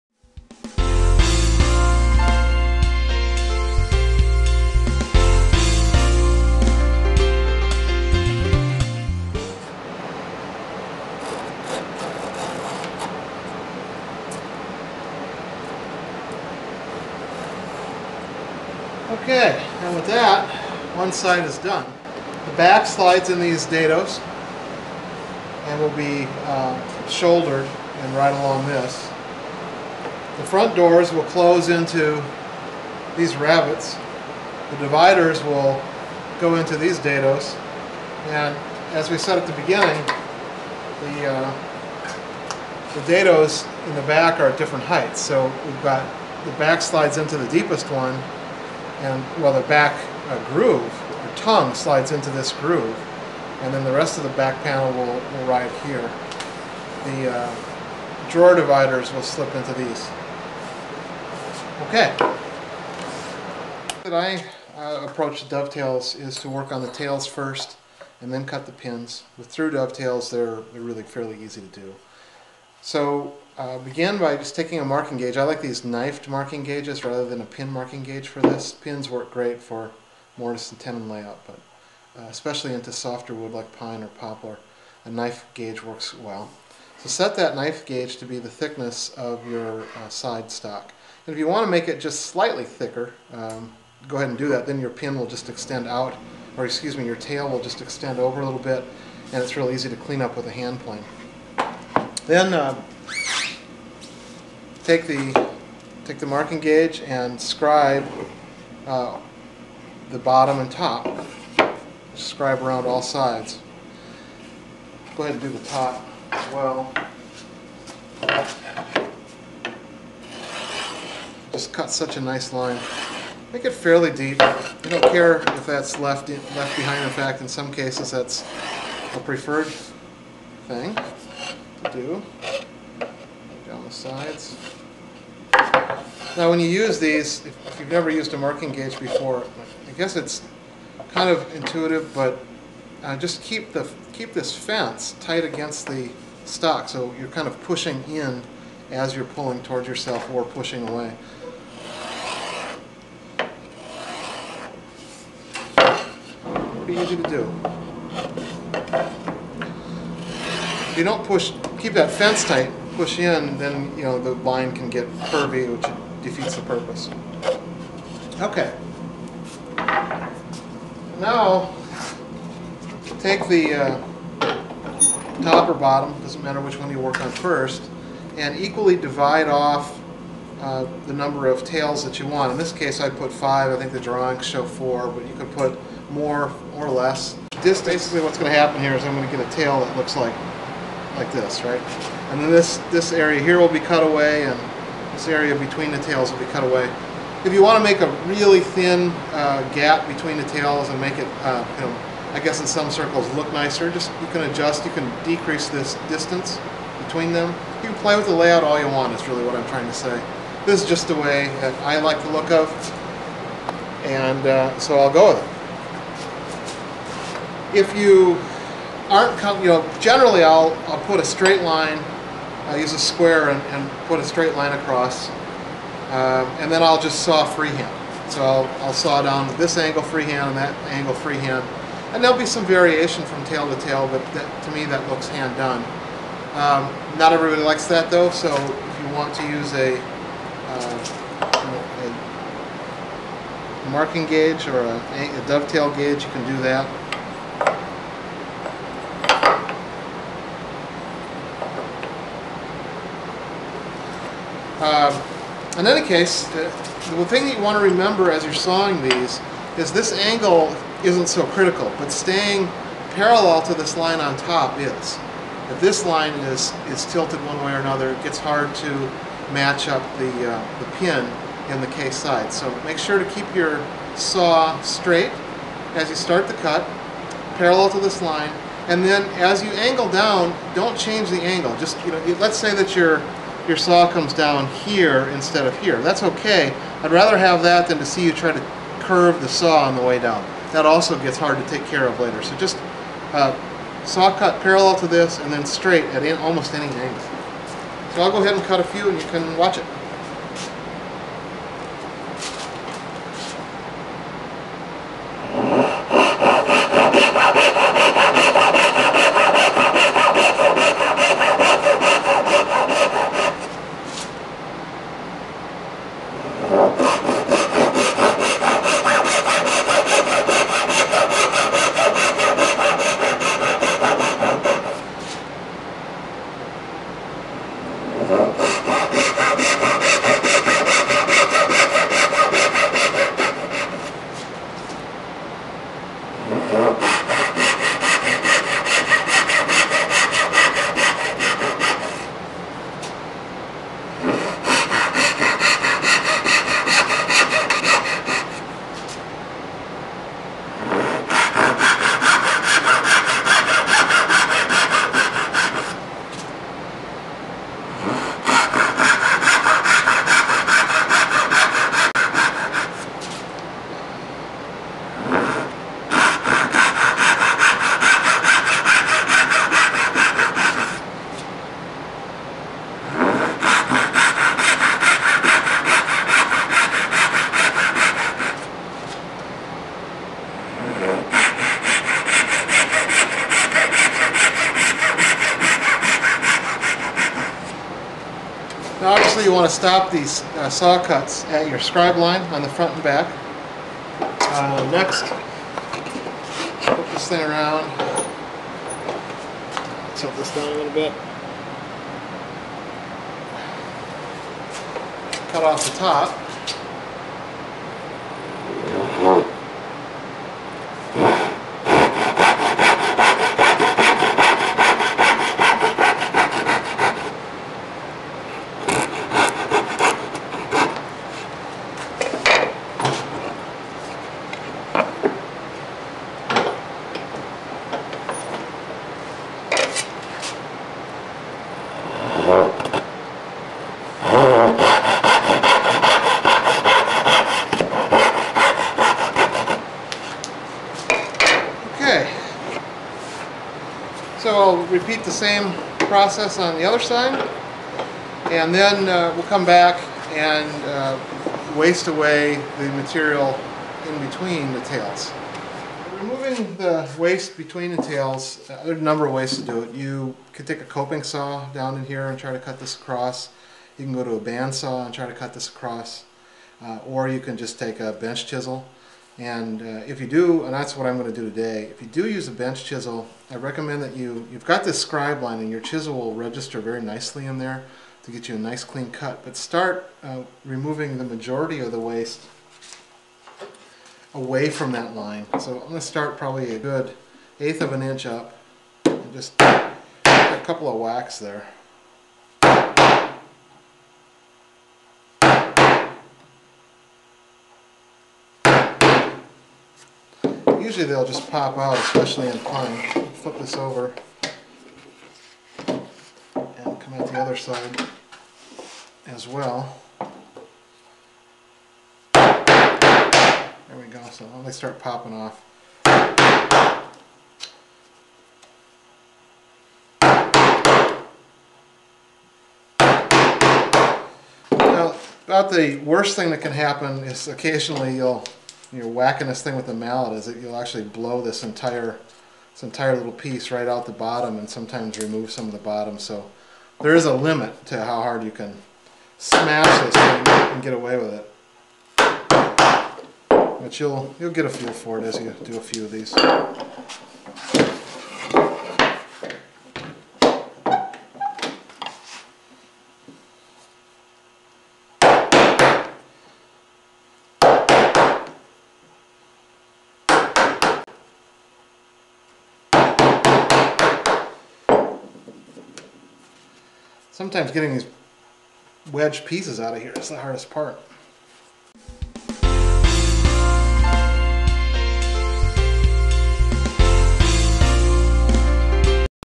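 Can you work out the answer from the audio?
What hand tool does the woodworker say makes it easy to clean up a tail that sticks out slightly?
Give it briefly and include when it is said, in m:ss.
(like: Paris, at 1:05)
Hand plane, at 1:40.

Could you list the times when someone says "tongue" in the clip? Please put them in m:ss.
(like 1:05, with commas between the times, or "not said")
0:51.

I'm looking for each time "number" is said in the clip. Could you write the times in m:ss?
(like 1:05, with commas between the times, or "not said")
3:01, 7:39.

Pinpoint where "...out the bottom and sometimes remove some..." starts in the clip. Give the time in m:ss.
8:53.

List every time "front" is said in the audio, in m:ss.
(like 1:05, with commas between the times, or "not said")
0:30, 6:32.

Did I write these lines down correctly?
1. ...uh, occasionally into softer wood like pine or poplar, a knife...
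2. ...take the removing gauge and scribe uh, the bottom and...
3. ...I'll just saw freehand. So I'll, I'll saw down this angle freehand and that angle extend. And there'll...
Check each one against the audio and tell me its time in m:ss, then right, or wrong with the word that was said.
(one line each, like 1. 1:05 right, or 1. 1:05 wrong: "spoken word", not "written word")
1. 1:22 wrong: "especially", not "occasionally"
2. 1:46 wrong: "marking", not "removing"
3. 3:46 wrong: "freehand", not "extend".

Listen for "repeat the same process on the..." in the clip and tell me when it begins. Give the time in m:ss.
7:24.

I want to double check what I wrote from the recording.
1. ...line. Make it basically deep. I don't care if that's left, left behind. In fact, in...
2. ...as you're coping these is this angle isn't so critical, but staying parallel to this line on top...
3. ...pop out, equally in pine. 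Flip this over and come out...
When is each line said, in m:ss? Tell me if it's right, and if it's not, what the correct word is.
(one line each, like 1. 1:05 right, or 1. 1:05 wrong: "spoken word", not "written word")
1. 2:02 wrong: "fairly", not "basically"
2. 4:18 wrong: "sawing", not "coping"
3. 8:21 wrong: "especially", not "equally".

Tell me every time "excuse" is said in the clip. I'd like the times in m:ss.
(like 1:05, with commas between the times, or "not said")
1:36.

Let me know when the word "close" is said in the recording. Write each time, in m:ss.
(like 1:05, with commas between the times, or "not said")
0:31.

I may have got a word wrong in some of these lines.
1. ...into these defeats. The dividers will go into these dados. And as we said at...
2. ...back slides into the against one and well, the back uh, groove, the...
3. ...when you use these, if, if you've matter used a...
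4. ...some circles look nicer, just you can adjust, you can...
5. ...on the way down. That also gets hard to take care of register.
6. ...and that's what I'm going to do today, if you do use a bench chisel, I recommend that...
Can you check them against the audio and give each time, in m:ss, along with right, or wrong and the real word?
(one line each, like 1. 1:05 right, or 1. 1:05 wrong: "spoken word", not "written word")
1. 0:31 wrong: "rabbets", not "defeats"
2. 0:46 wrong: "deepest", not "against"
3. 2:16 wrong: "never", not "matter"
4. 3:22 right
5. 4:49 wrong: "later", not "register"
6. 7:50 right.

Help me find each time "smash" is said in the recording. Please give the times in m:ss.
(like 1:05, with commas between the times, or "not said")
8:59.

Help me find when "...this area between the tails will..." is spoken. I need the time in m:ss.
3:15.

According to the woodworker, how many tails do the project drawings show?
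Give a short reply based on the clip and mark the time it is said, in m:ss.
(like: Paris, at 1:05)
4, at 3:04.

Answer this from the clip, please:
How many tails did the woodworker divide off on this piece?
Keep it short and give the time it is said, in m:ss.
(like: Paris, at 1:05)
5, at 3:03.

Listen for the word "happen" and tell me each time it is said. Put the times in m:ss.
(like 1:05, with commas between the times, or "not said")
3:08, 8:46.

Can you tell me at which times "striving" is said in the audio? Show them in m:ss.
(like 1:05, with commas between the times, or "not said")
not said.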